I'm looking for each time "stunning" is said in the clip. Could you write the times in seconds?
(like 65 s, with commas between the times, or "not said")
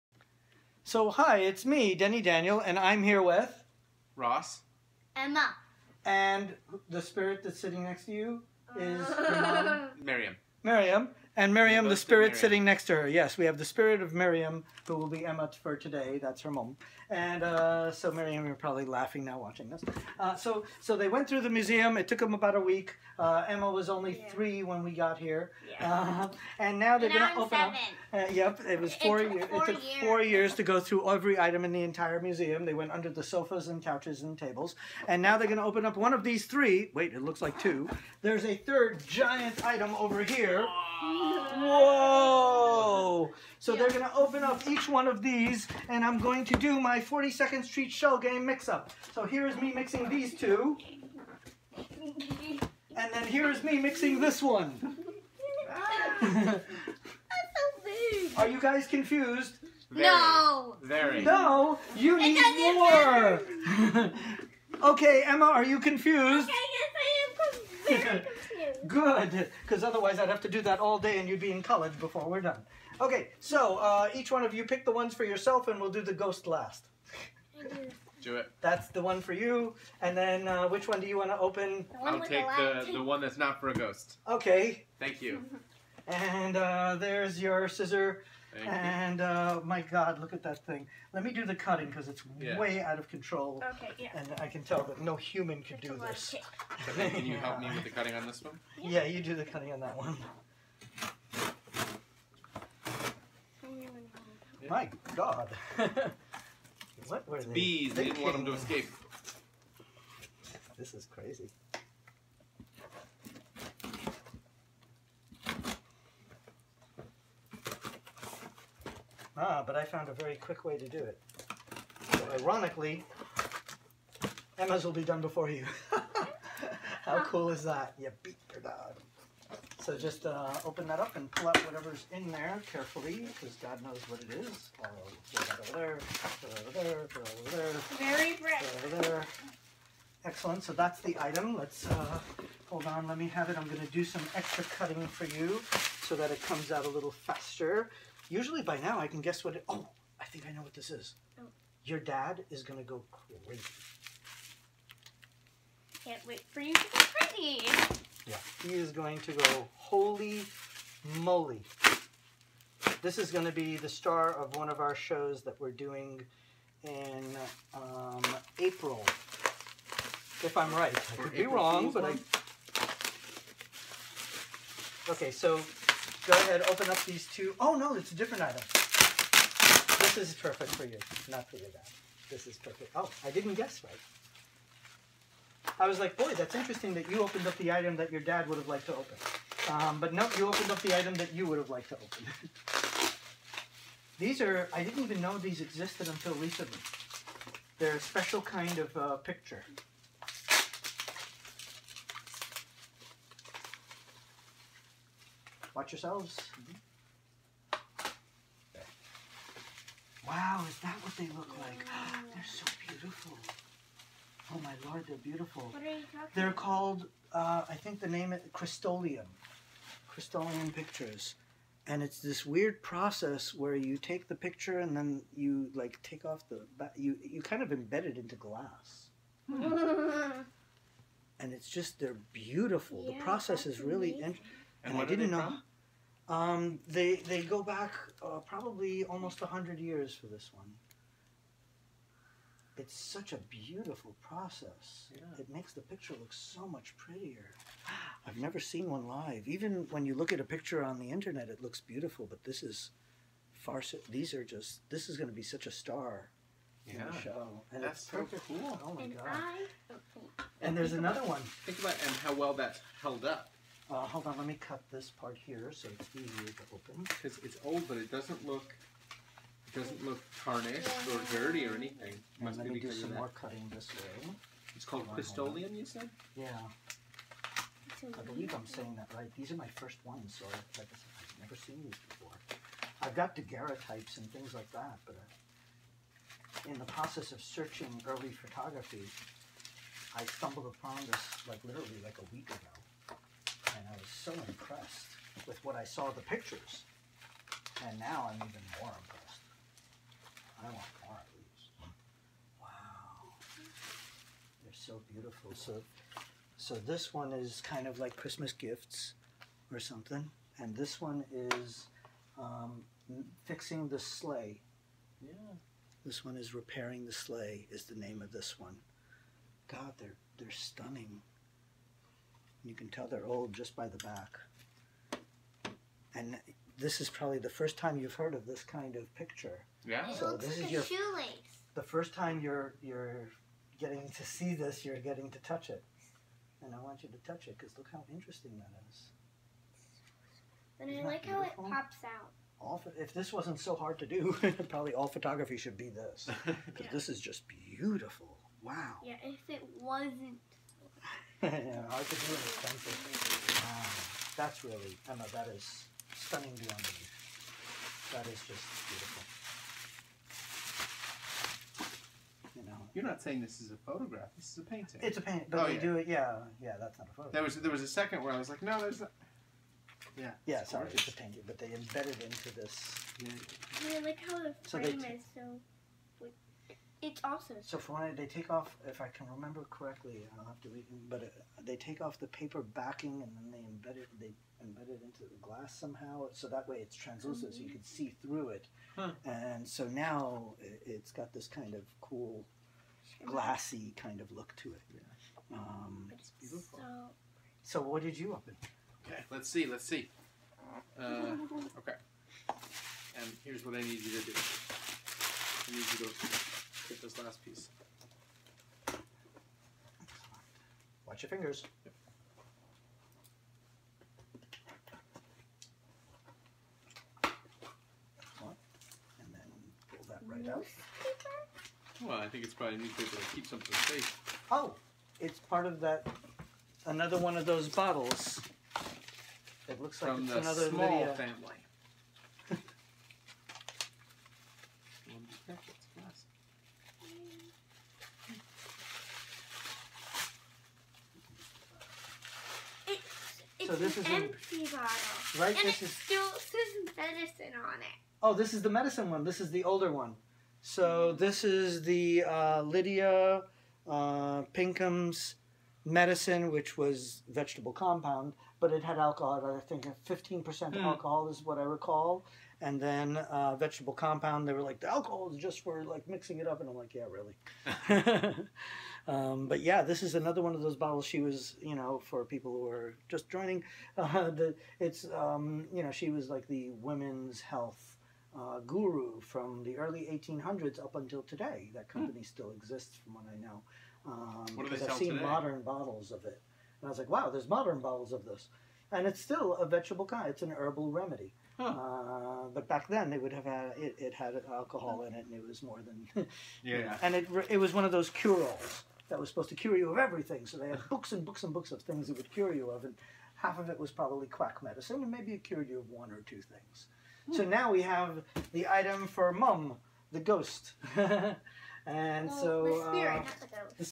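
320 s, 356 s.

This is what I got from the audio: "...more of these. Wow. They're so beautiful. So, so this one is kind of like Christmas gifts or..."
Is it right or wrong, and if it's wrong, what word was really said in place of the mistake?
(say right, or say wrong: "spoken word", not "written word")
right.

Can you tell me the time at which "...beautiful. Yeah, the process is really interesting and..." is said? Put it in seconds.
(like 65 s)
232 s.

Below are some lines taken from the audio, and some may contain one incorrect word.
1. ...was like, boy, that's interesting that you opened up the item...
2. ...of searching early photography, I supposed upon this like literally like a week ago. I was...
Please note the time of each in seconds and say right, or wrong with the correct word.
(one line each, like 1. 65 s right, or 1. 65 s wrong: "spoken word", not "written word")
1. 185 s right
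2. 287 s wrong: "stumbled", not "supposed".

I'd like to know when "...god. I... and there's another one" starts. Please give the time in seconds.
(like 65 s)
259 s.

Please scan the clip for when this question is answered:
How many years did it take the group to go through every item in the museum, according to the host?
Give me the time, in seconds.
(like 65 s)
30 s.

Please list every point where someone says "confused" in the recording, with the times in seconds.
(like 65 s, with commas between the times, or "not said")
58 s, 65 s.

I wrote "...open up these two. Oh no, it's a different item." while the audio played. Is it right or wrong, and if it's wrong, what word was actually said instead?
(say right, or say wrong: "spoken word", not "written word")
right.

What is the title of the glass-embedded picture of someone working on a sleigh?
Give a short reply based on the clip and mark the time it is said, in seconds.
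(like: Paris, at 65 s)
Repairing the sleigh, at 316 s.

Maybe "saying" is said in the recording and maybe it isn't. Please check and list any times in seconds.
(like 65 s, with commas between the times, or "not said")
278 s, 363 s.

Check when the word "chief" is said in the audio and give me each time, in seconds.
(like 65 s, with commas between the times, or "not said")
not said.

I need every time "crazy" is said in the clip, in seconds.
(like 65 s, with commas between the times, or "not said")
111 s, 153 s, 157 s.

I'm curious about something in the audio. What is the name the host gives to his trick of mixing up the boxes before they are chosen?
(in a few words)
42nd Street Shell Game.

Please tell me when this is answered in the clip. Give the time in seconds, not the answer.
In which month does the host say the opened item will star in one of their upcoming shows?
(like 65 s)
168 s.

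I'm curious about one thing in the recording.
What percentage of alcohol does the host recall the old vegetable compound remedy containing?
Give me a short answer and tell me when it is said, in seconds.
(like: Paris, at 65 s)
15%, at 460 s.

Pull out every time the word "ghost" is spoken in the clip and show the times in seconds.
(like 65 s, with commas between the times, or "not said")
76 s, 83 s, 510 s.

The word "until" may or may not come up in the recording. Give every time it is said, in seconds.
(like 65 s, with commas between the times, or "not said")
196 s, 480 s.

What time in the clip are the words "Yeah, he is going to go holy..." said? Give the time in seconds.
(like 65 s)
158 s.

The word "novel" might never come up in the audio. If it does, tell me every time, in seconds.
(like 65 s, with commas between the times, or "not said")
not said.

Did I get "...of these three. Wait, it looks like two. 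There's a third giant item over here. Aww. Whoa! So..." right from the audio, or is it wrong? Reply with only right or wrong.
right.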